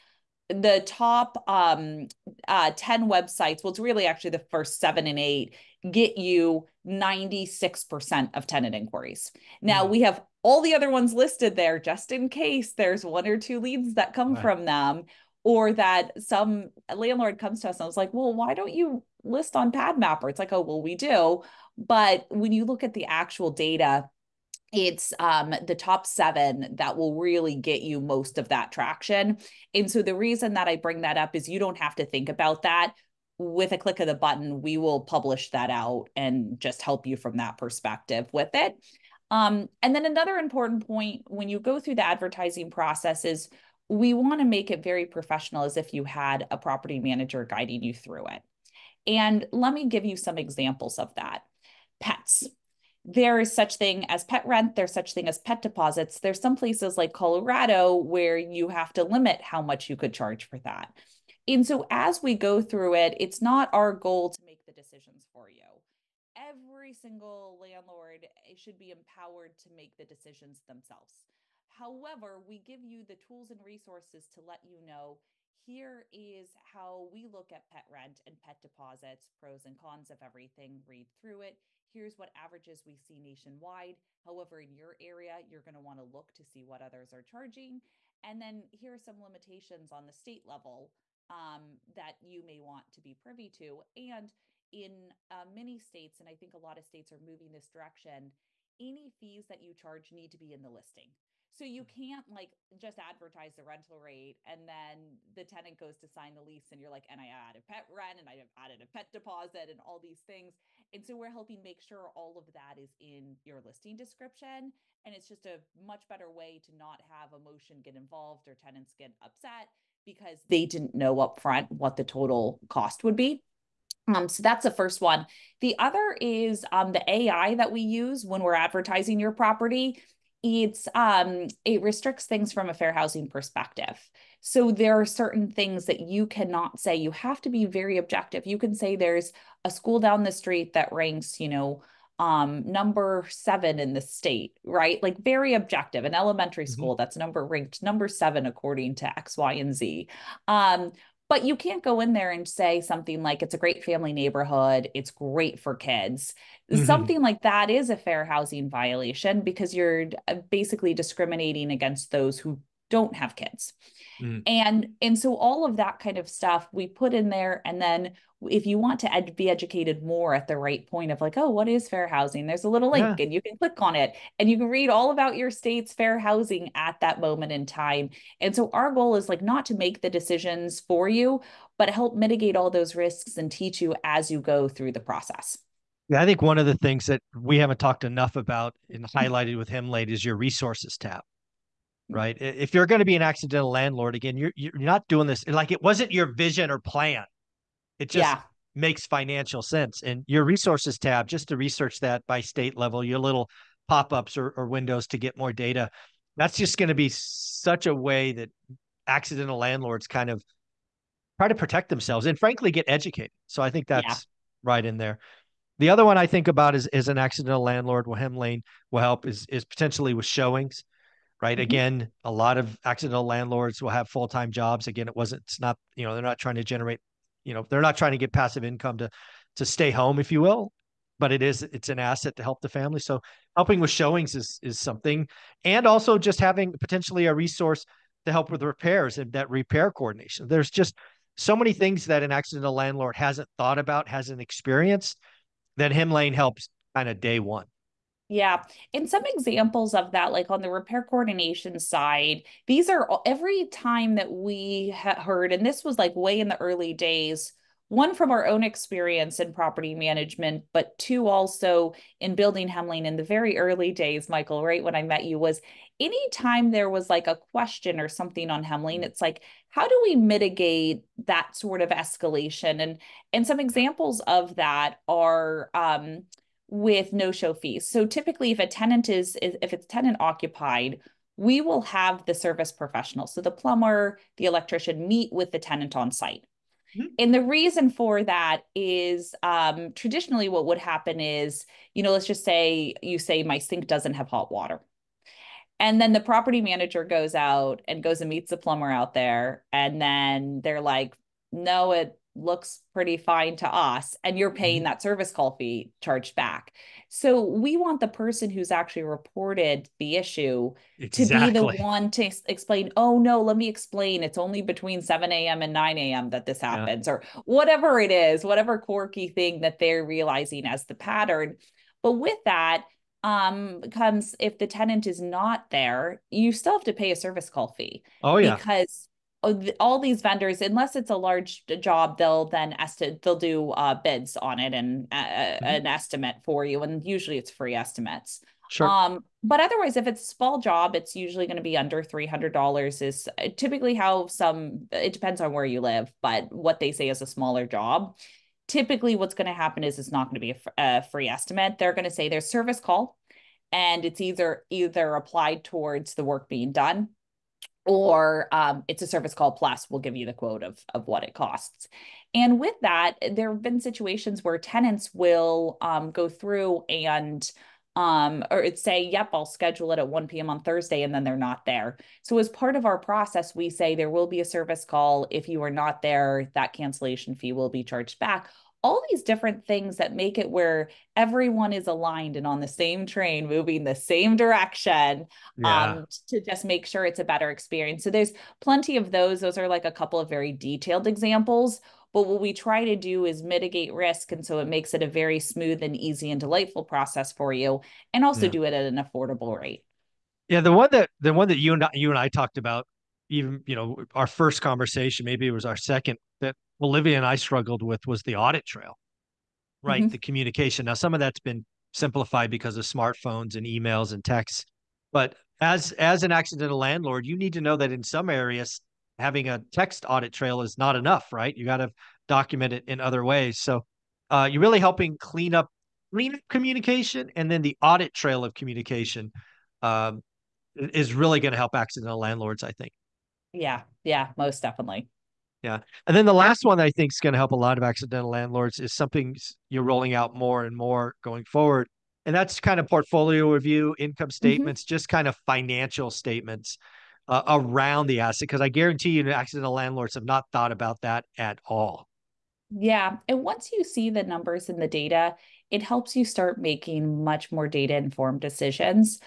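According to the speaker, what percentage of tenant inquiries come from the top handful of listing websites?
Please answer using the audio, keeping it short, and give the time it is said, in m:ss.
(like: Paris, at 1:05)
96%, at 0:06.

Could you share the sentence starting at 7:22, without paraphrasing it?
And that's kind of portfolio review, income mm-hmm.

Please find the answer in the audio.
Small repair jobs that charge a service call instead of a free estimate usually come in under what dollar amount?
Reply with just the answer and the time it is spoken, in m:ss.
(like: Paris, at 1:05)
$300, at 5:42.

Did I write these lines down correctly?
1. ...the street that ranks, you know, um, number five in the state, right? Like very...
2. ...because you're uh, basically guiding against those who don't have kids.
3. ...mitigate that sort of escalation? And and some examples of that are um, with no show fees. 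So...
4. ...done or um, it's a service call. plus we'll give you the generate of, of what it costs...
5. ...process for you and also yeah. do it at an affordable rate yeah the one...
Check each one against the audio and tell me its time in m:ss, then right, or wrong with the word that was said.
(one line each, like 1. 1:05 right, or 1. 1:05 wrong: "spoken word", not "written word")
1. 2:20 wrong: "seven", not "five"
2. 2:39 wrong: "discriminating", not "guiding"
3. 4:30 right
4. 5:56 wrong: "quote", not "generate"
5. 6:36 right.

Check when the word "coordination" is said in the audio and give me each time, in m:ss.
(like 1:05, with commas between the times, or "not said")
3:59, 4:11.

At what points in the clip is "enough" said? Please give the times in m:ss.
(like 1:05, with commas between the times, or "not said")
3:08, 7:00.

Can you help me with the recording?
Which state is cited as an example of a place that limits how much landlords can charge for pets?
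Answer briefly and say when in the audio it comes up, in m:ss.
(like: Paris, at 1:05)
Colorado, at 0:57.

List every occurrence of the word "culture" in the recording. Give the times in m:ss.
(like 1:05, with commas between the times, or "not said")
not said.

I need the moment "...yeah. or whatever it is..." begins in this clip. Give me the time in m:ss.
5:17.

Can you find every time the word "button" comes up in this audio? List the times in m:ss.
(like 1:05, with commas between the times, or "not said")
0:34.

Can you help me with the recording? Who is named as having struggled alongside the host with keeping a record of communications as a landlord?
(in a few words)
Olivia.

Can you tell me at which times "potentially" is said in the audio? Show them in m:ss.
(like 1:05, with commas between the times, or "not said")
3:39, 3:56.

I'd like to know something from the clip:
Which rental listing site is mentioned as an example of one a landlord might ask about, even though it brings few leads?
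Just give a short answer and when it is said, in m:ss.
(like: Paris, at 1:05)
PadMapper, at 0:19.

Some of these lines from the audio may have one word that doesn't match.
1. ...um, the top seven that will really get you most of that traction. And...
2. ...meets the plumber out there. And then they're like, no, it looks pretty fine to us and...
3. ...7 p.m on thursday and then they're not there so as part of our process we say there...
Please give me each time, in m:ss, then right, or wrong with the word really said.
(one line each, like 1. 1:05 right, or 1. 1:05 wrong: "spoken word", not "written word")
1. 0:25 right
2. 4:58 right
3. 6:10 wrong: "1", not "7".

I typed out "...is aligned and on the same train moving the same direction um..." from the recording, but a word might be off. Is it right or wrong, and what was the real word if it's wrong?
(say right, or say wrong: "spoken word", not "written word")
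right.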